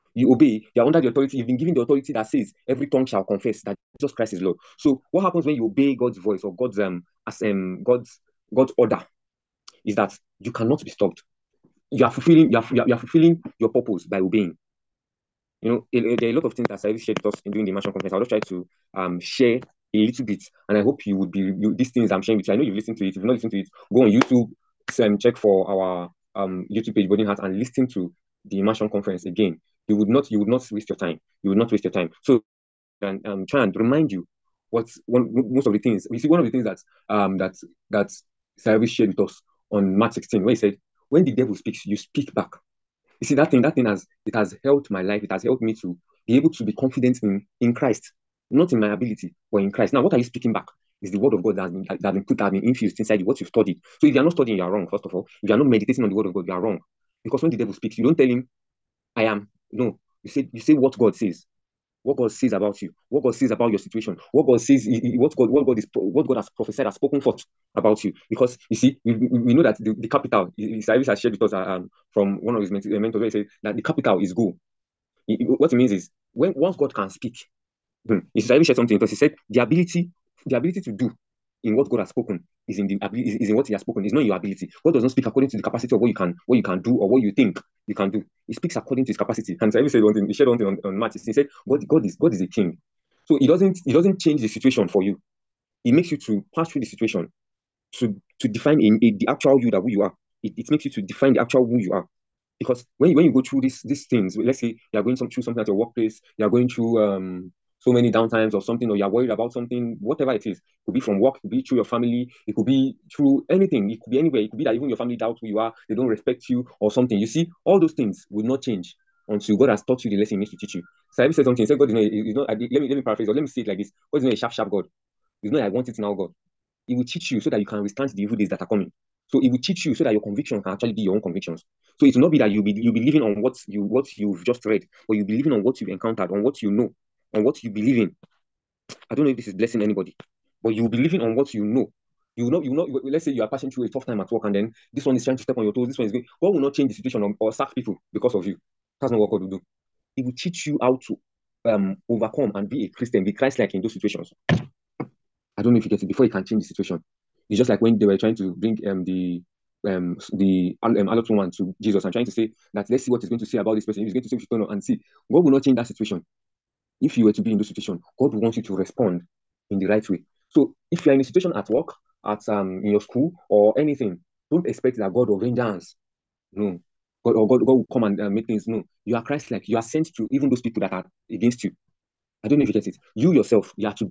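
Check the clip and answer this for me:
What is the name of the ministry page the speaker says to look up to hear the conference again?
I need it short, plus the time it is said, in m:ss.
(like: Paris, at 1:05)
Burning Heart, at 0:27.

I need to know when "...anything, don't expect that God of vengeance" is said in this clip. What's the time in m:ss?
2:53.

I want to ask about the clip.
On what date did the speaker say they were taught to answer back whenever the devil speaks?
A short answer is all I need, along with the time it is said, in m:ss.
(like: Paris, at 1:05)
March 16, at 0:39.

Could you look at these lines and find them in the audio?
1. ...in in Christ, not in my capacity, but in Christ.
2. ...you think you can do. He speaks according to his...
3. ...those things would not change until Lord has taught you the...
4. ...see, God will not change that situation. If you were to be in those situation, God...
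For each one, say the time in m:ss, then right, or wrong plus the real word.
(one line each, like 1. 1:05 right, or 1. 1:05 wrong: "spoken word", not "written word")
1. 0:47 wrong: "ability", not "capacity"
2. 1:27 right
3. 1:57 wrong: "God", not "Lord"
4. 2:44 right.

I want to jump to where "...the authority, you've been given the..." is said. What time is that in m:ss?
0:00.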